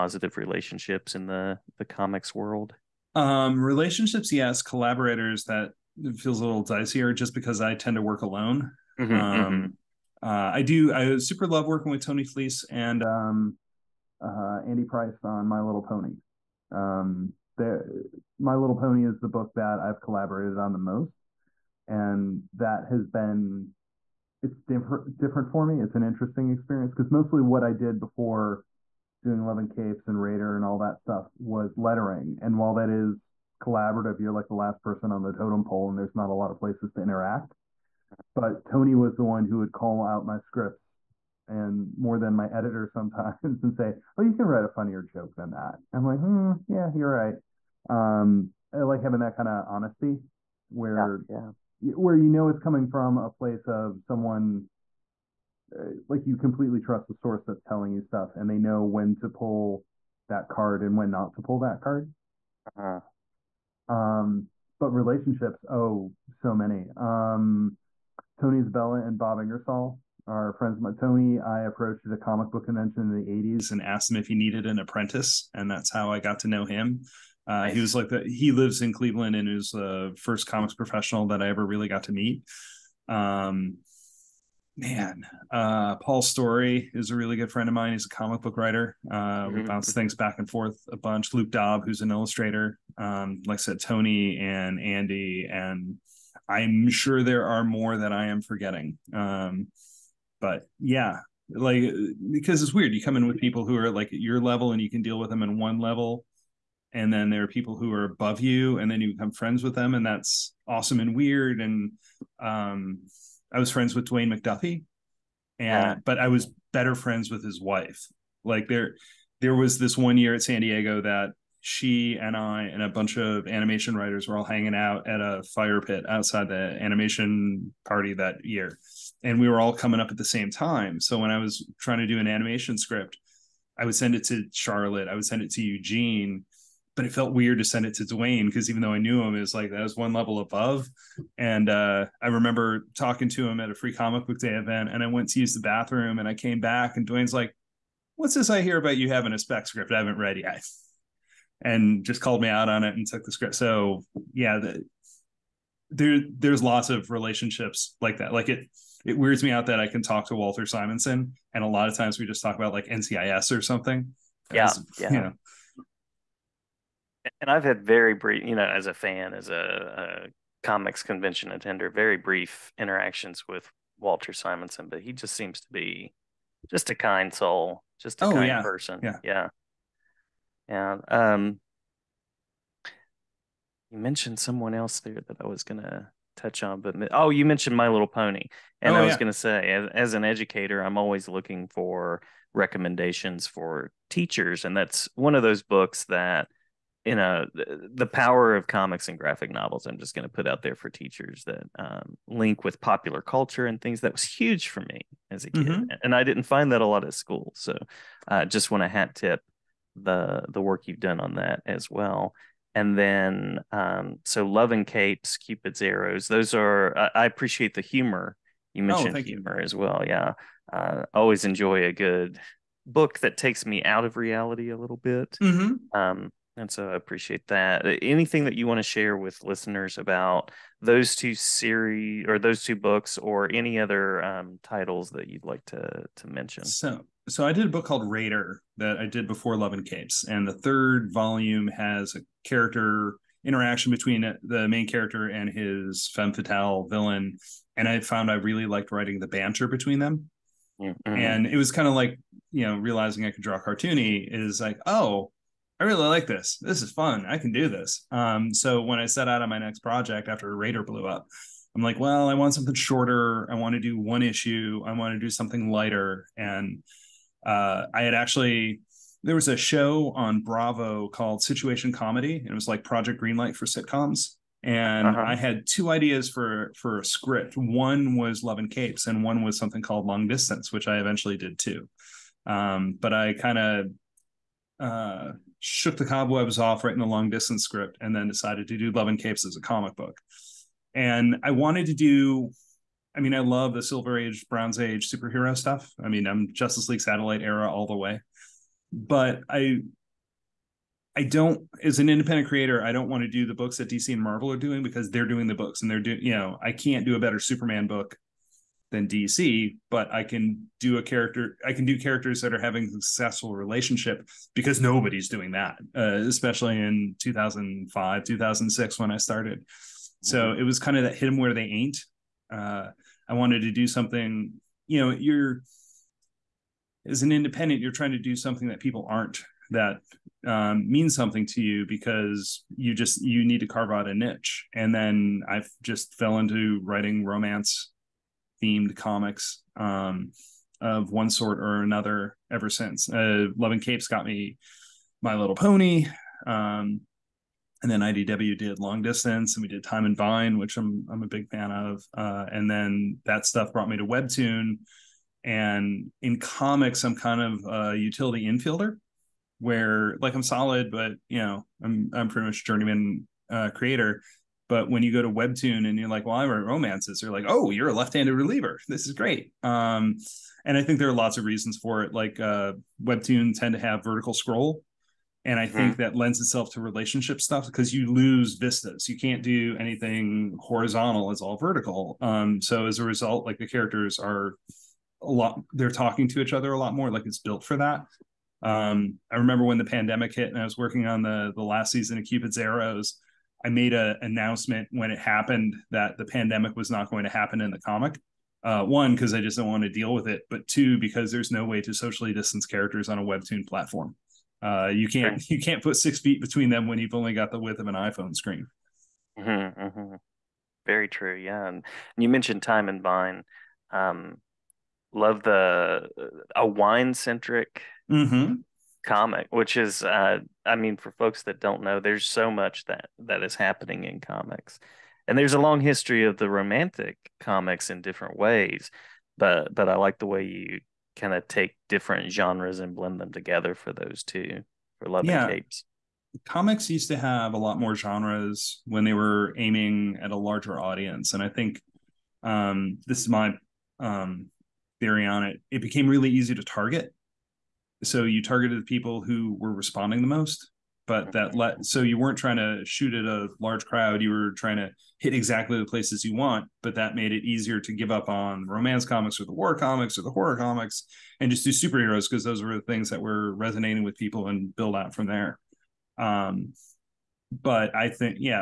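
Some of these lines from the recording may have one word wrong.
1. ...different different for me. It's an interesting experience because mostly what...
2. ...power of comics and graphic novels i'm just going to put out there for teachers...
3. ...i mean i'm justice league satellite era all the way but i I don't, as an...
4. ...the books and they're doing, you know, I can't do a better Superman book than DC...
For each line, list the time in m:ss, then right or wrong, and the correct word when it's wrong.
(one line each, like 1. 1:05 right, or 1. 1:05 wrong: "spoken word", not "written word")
1. 0:24 right
2. 3:18 right
3. 4:56 right
4. 5:05 right.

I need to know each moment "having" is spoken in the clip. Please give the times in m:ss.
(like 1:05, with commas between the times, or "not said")
0:49, 2:29, 5:12.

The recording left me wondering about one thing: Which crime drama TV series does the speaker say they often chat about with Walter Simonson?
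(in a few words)
NCIS.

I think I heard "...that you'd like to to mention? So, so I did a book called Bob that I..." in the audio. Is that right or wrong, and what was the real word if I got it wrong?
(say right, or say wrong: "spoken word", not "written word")
wrong: "Raider", not "Bob".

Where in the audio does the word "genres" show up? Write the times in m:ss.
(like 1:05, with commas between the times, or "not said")
7:12, 7:17.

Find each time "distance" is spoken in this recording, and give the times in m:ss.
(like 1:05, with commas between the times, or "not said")
4:40, 4:47, 5:49, 6:42.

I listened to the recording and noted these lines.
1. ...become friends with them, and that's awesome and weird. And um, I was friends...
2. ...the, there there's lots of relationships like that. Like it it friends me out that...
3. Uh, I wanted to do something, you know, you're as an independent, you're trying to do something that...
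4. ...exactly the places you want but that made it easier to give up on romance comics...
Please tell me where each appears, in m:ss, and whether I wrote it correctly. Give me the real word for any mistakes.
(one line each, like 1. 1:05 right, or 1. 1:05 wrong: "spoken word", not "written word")
1. 1:49 right
2. 2:34 wrong: "weirds", not "friends"
3. 5:22 right
4. 7:35 right.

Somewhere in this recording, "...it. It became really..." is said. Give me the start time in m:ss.
7:25.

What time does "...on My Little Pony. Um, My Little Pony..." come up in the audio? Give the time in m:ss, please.
0:15.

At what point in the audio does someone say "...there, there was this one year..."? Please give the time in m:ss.
1:58.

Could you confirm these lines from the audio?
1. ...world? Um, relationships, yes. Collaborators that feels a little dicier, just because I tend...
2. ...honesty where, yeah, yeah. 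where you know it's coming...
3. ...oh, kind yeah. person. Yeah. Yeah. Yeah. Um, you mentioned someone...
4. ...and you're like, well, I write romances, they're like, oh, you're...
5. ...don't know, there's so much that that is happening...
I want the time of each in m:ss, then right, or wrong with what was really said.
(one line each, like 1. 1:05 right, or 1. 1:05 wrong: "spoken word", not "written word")
1. 0:02 right
2. 0:49 right
3. 2:58 right
4. 6:05 right
5. 7:01 right.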